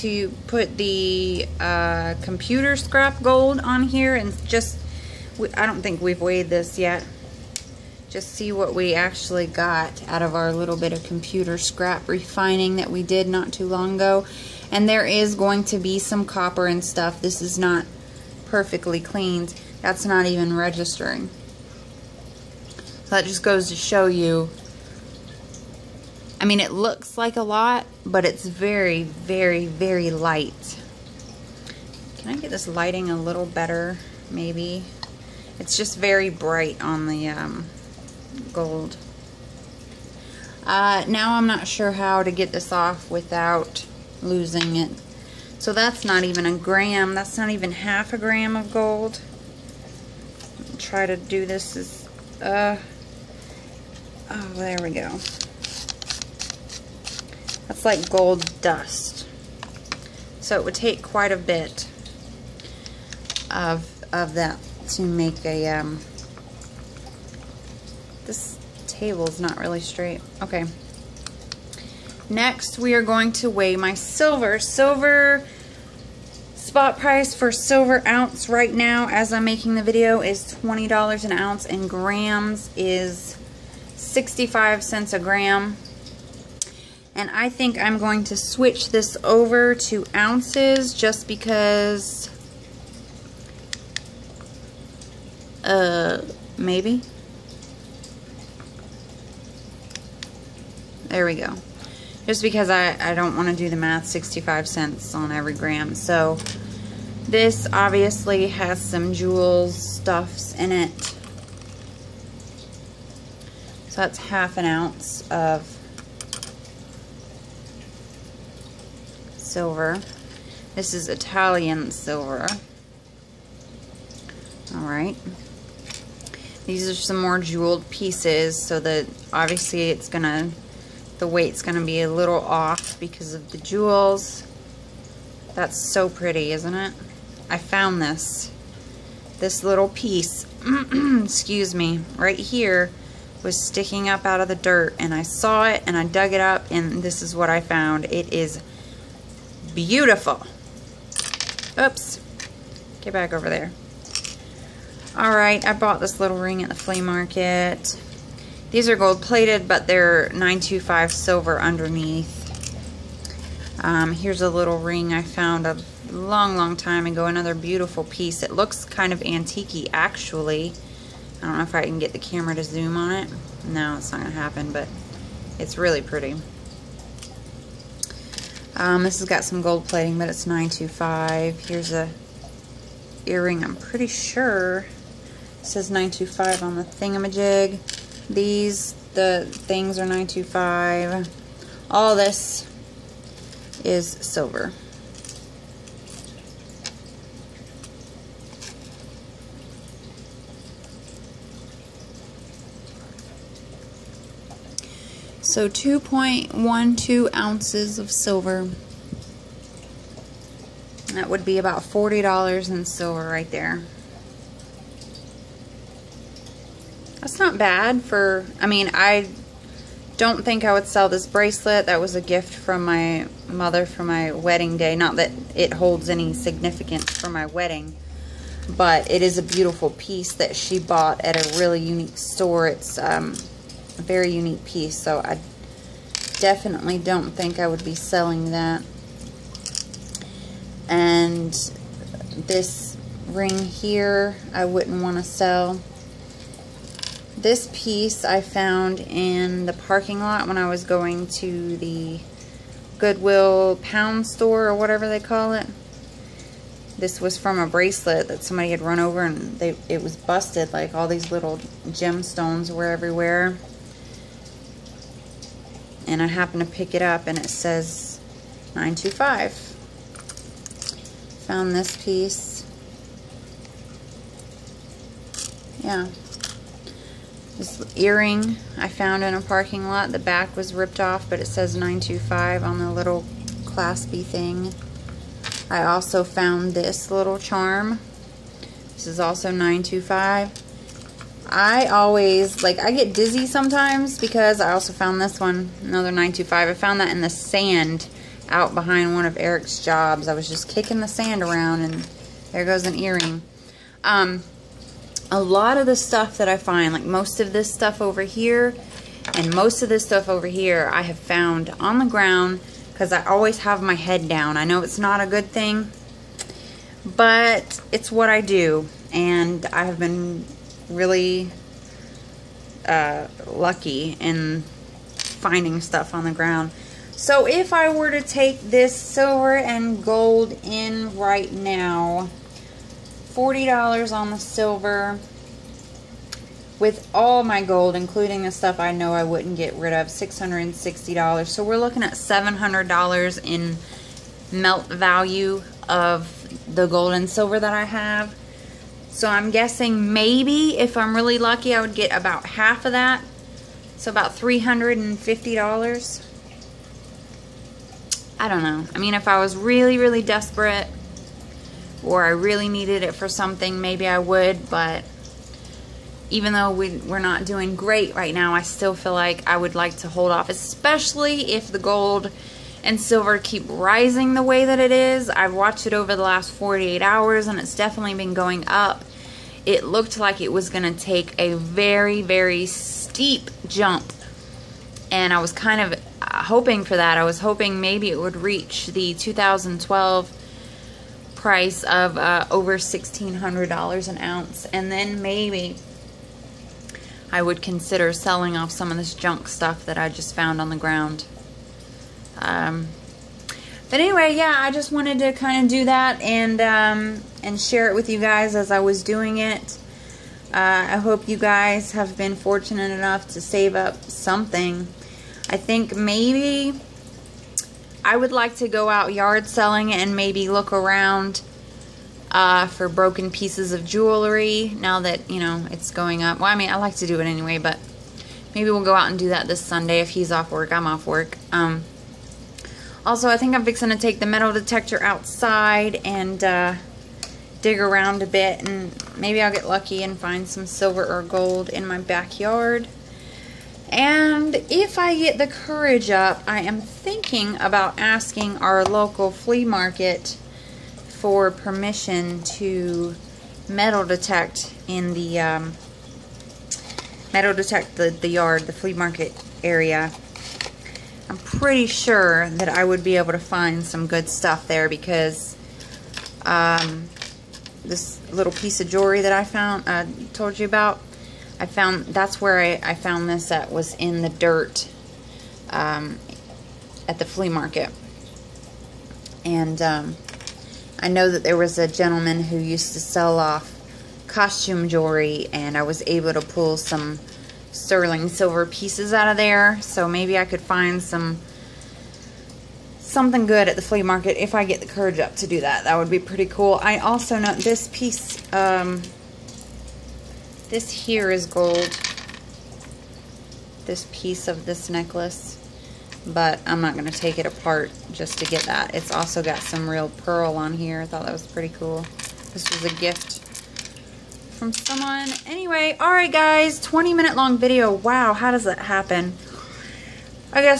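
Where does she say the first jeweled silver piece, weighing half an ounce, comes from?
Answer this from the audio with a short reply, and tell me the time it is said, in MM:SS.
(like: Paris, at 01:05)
Italian, at 02:01.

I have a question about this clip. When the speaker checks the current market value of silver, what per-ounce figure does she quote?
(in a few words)
$20.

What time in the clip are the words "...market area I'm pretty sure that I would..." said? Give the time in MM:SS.
07:38.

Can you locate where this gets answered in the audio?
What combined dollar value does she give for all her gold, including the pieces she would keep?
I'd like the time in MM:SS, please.
05:40.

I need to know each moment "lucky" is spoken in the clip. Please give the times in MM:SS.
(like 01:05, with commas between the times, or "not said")
05:23, 05:51, 07:19.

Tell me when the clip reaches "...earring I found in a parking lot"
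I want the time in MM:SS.
04:37.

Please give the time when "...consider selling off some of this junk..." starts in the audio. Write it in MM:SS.
06:37.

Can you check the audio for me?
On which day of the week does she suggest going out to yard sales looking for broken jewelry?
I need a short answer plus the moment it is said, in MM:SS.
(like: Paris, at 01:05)
Sunday, at 07:09.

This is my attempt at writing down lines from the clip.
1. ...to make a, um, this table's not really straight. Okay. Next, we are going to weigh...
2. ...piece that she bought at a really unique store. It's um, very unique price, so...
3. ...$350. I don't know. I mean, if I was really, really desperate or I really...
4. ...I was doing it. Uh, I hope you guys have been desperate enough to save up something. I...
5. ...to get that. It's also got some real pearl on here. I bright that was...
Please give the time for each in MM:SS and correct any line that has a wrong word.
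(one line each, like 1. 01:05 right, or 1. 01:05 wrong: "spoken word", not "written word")
1. 01:04 right
2. 03:49 wrong: "piece", not "price"
3. 05:54 right
4. 06:48 wrong: "fortunate", not "desperate"
5. 08:28 wrong: "thought", not "bright".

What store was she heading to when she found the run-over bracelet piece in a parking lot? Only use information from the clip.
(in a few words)
Goodwill pound store.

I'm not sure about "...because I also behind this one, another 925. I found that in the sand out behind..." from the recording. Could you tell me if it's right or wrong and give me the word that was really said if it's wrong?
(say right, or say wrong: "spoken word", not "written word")
wrong: "found", not "behind".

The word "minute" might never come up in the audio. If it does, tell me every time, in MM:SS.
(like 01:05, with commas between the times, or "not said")
08:37.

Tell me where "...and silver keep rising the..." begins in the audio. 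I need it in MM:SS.
06:12.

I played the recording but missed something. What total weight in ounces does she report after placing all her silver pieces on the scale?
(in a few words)
2.12 ounces.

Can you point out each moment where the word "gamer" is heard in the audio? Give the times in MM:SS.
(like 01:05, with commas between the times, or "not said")
not said.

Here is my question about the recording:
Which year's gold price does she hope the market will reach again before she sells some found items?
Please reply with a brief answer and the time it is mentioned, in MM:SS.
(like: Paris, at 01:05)
2012, at 06:29.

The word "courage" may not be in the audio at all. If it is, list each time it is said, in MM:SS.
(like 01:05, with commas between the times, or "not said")
07:25, 08:14.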